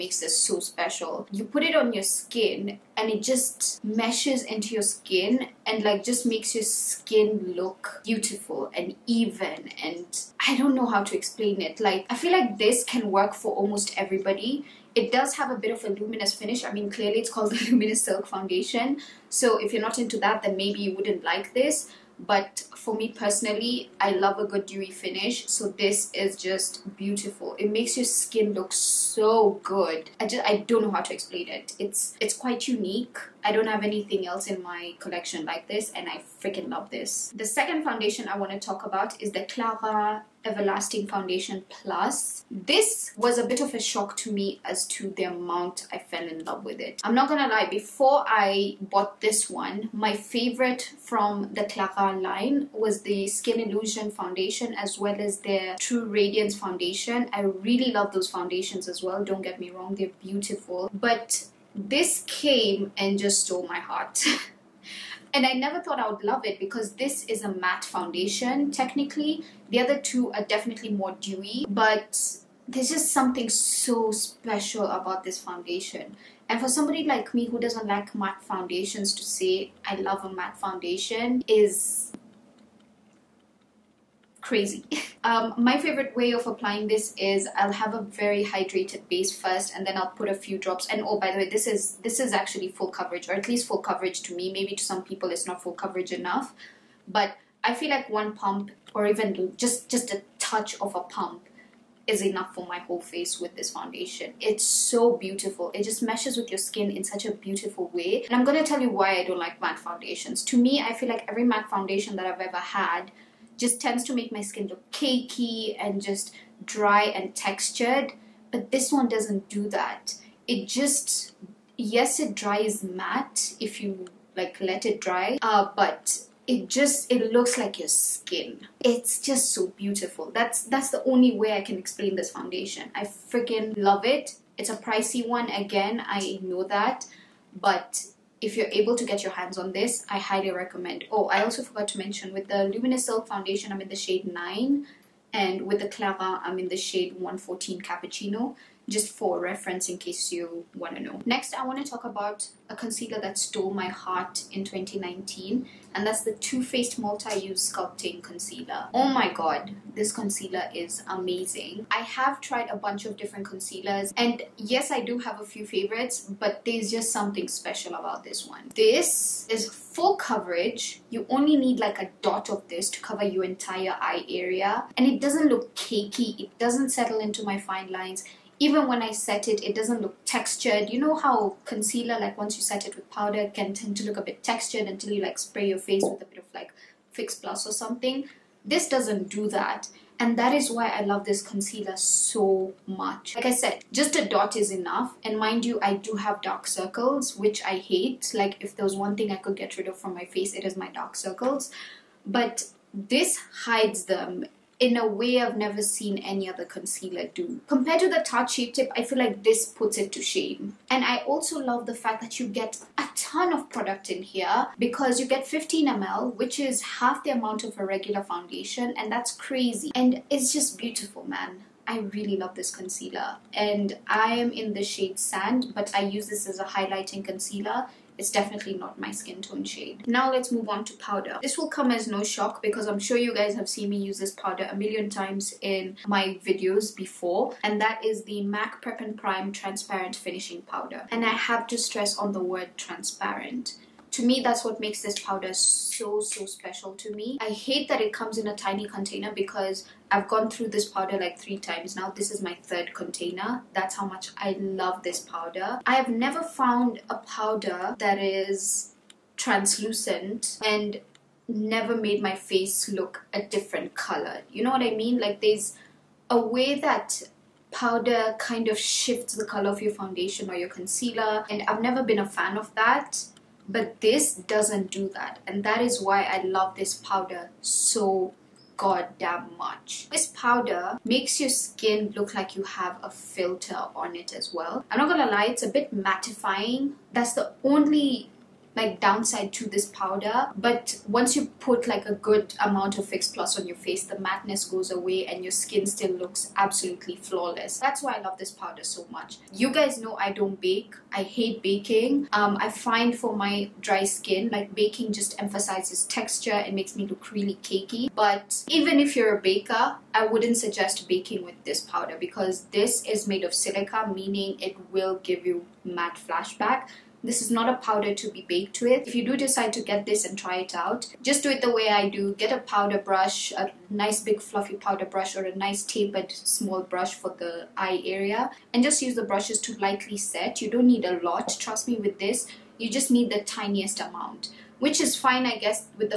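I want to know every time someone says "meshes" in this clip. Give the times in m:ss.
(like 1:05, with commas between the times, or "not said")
0:03, 1:46.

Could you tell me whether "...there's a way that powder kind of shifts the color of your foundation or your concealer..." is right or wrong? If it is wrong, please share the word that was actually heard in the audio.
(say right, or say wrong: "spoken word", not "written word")
right.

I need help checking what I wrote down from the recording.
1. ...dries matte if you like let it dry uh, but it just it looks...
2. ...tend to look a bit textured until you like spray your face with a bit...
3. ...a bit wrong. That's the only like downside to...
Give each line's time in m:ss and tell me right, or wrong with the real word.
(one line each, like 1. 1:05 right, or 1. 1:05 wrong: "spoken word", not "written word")
1. 2:02 right
2. 3:03 right
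3. 4:45 wrong: "mattifying", not "wrong".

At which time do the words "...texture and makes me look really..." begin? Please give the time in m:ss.
5:06.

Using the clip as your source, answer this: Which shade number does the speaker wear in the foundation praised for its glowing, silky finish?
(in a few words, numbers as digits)
9.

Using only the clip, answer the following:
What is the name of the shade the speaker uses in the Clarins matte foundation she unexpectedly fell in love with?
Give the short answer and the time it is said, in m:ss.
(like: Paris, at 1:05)
114 Cappuccino, at 2:27.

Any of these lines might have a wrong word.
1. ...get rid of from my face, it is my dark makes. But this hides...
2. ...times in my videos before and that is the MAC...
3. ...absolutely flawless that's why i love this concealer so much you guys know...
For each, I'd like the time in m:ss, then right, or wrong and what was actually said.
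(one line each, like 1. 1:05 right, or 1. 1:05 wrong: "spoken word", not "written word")
1. 3:19 wrong: "circles", not "makes"
2. 3:55 right
3. 4:56 wrong: "powder", not "concealer".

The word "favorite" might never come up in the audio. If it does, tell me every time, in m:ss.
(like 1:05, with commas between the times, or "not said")
0:50, 1:25, 2:45.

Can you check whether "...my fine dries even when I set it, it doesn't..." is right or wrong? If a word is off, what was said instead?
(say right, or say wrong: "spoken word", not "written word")
wrong: "lines", not "dries".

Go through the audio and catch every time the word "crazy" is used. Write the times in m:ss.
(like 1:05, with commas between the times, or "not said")
1:24, 3:39.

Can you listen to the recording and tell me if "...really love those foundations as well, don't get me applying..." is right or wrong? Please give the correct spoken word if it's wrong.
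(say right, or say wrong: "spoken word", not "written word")
wrong: "wrong", not "applying".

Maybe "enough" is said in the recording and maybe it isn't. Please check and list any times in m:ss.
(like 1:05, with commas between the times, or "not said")
1:36, 1:42, 3:14.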